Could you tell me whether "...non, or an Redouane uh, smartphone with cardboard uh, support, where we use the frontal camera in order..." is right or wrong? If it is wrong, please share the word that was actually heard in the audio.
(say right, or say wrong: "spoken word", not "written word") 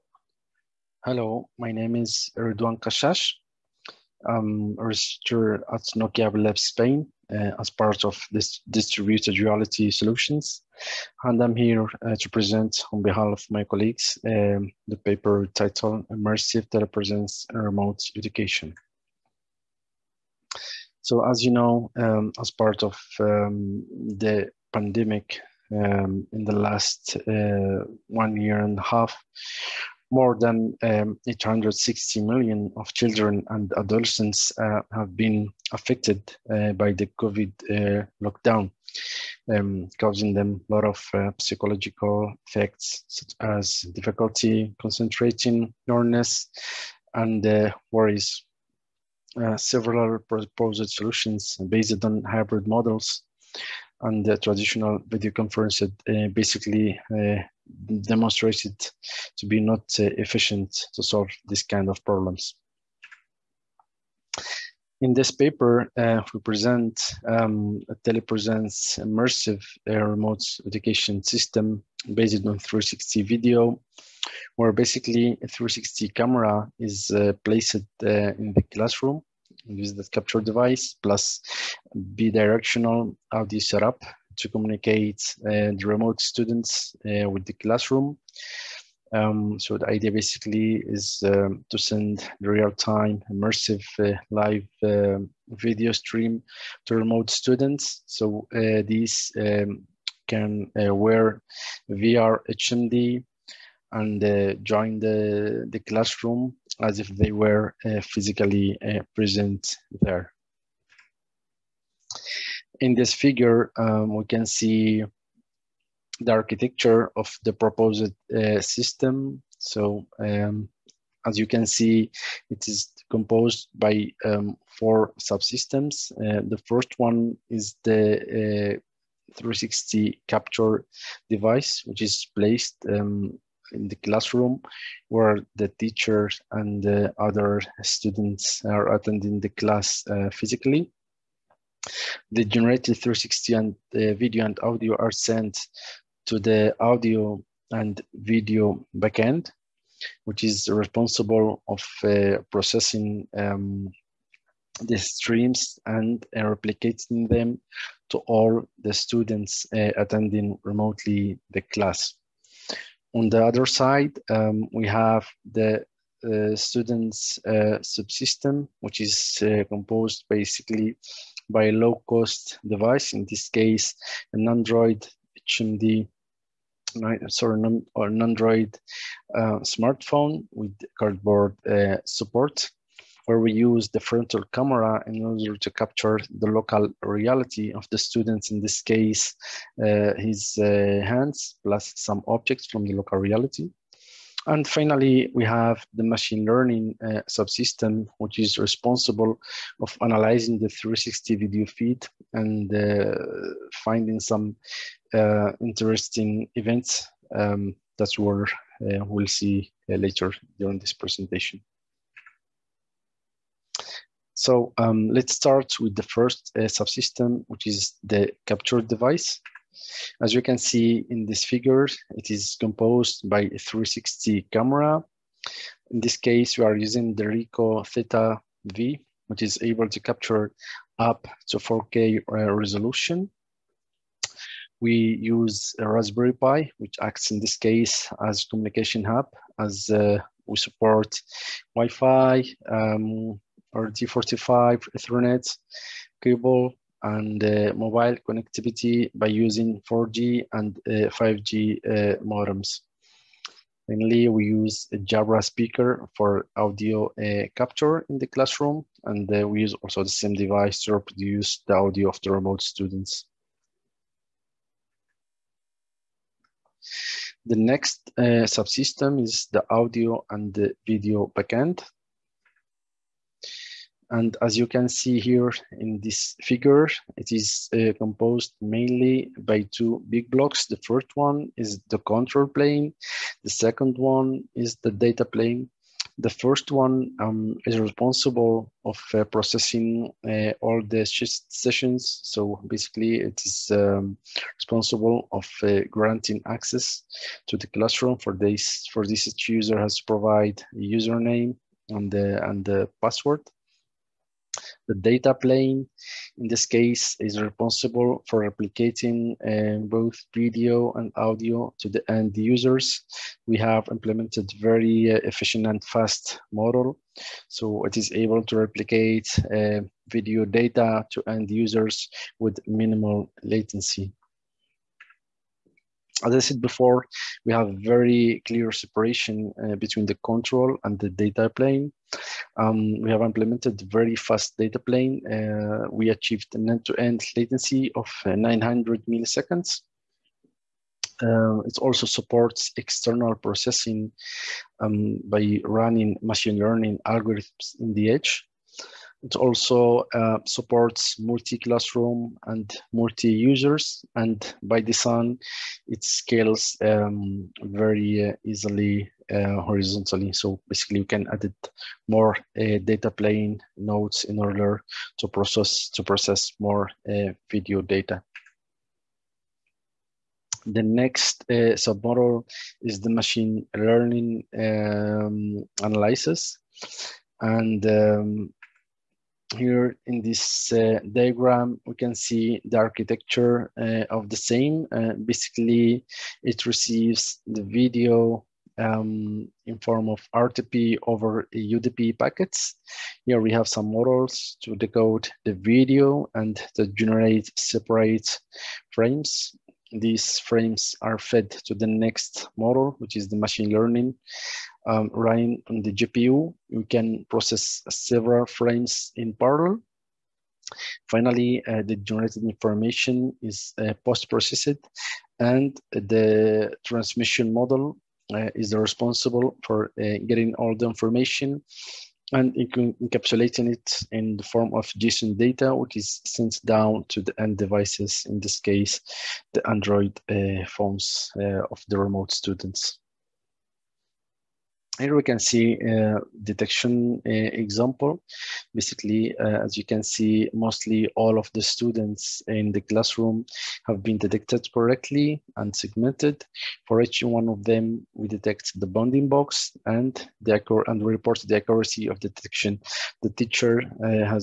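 wrong: "Android", not "Redouane".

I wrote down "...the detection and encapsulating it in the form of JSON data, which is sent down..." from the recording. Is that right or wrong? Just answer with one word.
wrong.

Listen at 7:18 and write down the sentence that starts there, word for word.
Basically, uh, as you can see, mostly all of the students in the classroom have been detected correctly and segmented.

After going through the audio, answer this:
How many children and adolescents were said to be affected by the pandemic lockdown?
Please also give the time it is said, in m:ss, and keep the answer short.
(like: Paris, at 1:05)
860 million, at 0:31.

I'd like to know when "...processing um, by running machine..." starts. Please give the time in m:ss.
5:43.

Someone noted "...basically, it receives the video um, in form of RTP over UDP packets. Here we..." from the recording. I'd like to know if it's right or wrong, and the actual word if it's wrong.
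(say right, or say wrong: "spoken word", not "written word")
right.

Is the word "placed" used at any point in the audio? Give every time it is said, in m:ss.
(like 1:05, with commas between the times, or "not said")
1:17, 2:12.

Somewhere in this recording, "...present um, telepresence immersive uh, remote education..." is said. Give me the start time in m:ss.
1:06.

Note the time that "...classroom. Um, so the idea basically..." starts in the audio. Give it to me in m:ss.
1:27.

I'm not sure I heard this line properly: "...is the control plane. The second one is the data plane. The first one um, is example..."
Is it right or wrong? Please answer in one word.
wrong.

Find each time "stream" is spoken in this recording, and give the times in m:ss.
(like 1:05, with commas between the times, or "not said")
1:35, 2:34.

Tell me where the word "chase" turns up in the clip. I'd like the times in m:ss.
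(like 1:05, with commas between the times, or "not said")
not said.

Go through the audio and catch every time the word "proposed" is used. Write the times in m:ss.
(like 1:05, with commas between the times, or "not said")
0:50, 1:57.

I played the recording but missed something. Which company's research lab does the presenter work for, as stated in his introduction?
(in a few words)
Nokia.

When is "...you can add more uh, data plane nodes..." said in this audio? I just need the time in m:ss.
6:01.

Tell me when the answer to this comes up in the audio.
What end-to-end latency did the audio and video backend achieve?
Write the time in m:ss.
5:38.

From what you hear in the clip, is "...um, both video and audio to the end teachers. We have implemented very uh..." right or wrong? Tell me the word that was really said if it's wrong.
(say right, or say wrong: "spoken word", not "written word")
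wrong: "users", not "teachers".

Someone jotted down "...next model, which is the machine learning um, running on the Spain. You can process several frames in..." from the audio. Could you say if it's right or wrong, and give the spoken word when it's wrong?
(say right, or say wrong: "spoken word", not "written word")
wrong: "GPU", not "Spain".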